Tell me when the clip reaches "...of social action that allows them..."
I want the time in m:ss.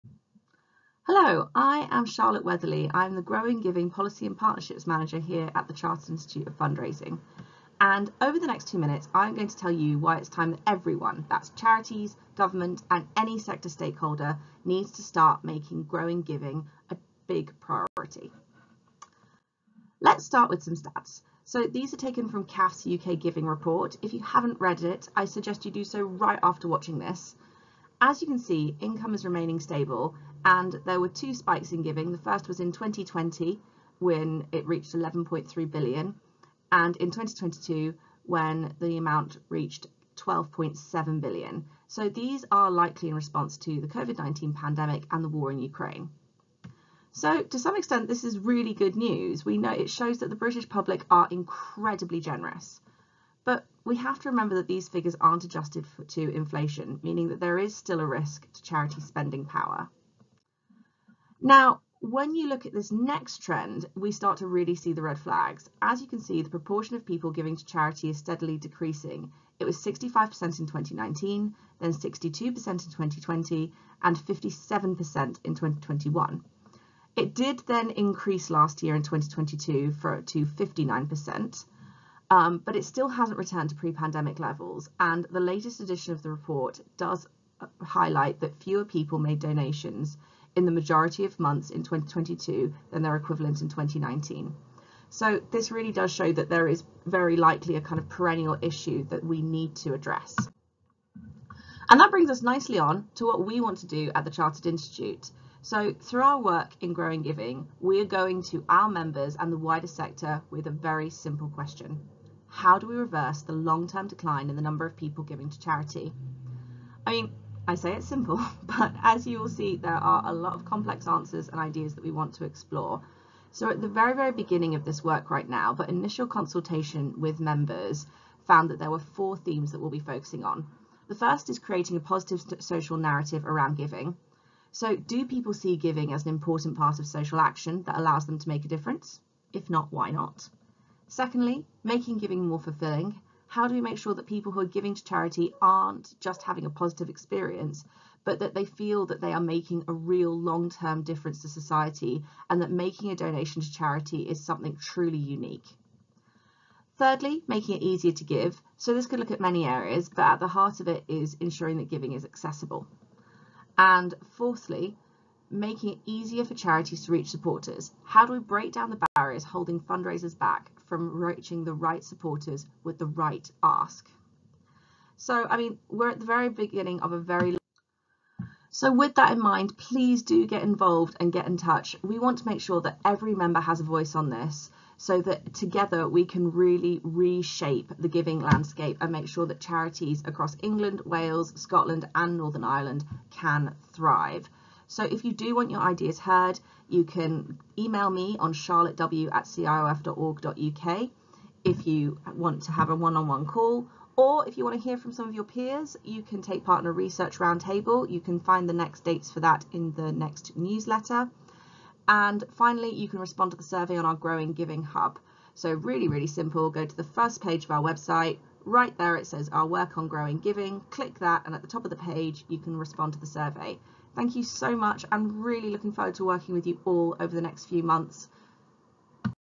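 2:16.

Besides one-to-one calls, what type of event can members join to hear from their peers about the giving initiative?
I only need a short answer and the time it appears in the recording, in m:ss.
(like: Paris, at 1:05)
Research roundtable, at 3:26.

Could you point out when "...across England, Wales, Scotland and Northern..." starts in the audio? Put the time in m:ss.
3:10.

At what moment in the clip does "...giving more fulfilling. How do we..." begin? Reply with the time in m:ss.
2:22.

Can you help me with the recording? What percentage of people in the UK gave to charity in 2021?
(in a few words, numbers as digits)
57%.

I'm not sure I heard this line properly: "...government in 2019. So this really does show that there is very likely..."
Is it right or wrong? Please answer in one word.
wrong.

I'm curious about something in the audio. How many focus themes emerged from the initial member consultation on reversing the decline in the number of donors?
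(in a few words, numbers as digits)
4.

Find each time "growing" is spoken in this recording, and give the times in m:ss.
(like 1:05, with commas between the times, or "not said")
0:03, 0:15, 1:46, 3:34, 3:40.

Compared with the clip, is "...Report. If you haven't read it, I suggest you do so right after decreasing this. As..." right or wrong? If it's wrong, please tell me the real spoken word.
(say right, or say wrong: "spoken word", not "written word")
wrong: "watching", not "decreasing".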